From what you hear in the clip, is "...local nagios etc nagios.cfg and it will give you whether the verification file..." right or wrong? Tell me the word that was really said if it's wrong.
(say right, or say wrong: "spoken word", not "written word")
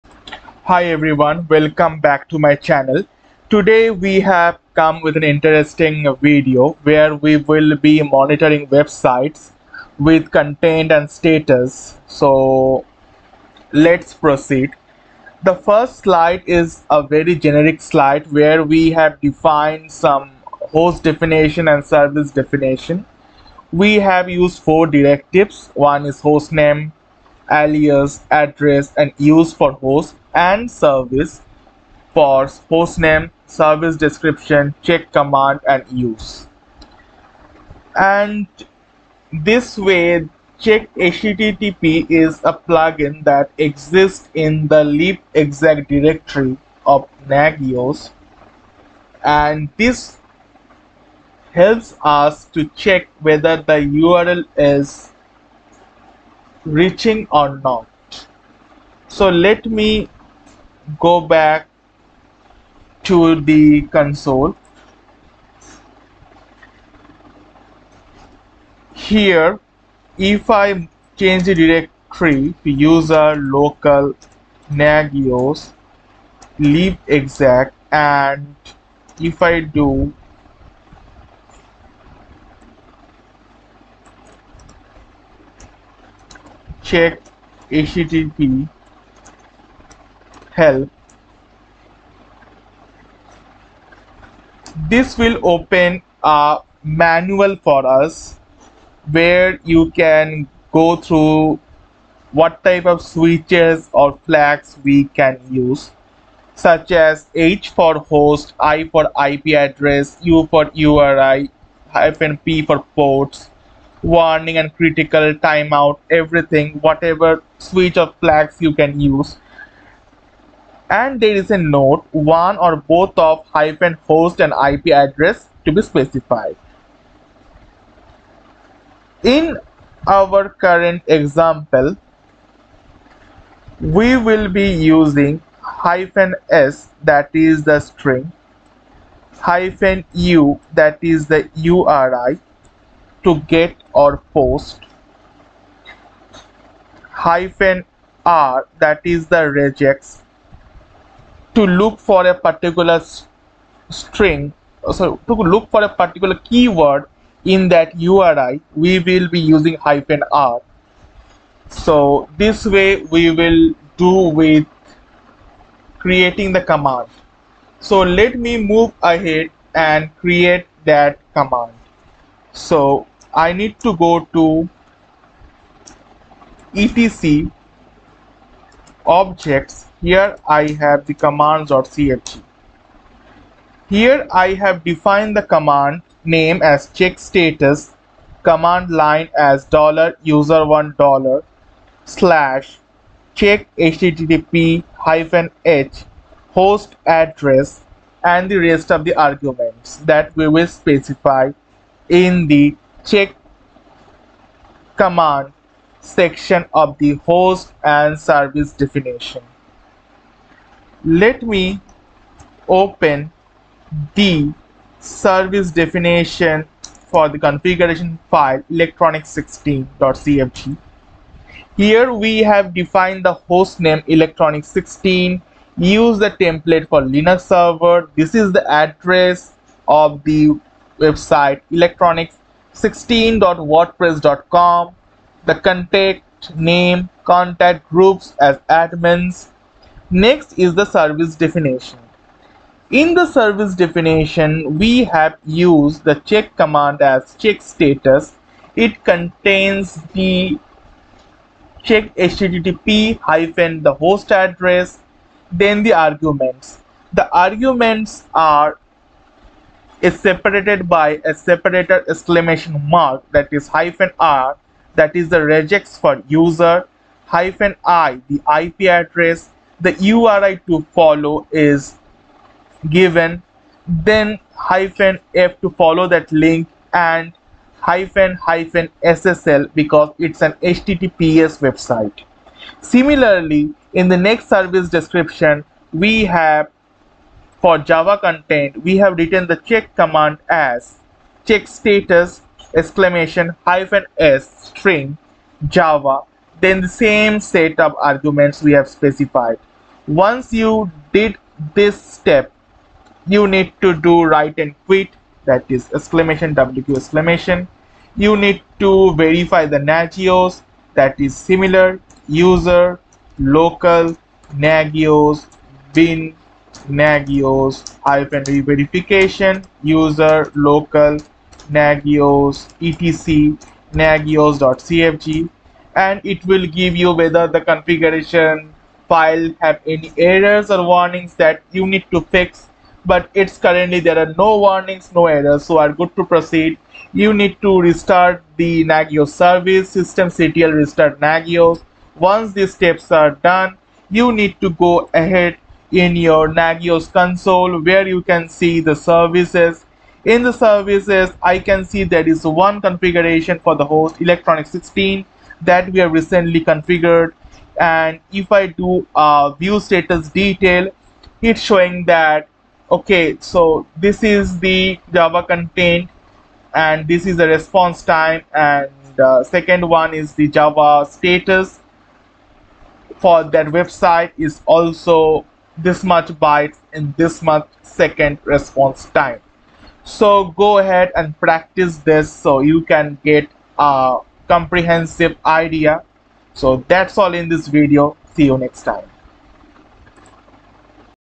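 wrong: "configuration", not "verification".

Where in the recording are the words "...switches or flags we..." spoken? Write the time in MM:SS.
01:43.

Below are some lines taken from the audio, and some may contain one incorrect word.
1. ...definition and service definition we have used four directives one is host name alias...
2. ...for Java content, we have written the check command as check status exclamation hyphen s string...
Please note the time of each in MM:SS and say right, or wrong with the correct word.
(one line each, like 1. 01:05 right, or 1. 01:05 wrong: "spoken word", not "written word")
1. 00:21 right
2. 04:47 right.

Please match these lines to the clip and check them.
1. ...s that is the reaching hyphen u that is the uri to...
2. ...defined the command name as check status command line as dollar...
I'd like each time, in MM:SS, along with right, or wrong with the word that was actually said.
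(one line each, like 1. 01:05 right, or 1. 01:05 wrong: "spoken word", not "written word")
1. 02:16 wrong: "string", not "reaching"
2. 03:04 right.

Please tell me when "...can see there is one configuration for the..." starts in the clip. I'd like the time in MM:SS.
05:51.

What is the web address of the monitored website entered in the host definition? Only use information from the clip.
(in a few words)
electronics16.wordpress.com.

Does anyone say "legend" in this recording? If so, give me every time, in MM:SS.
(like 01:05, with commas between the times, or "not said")
not said.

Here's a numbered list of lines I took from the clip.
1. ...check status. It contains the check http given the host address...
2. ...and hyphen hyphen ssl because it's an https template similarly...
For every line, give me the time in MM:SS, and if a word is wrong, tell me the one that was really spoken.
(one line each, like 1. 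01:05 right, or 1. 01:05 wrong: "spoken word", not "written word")
1. 04:07 wrong: "hyphen", not "given"
2. 04:36 wrong: "website", not "template".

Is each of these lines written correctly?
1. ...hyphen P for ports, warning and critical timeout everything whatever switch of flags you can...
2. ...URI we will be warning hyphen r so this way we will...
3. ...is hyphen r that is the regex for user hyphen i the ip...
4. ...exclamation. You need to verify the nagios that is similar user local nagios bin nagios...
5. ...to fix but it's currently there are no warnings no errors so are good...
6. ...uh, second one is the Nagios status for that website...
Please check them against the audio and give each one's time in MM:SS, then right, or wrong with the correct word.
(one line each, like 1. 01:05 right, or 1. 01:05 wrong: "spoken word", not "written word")
1. 01:51 right
2. 02:37 wrong: "using", not "warning"
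3. 04:23 right
4. 05:06 right
5. 05:32 right
6. 06:09 wrong: "Java", not "Nagios".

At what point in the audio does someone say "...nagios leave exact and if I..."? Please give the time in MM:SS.
01:14.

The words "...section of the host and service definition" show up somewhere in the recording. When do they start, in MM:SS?
03:26.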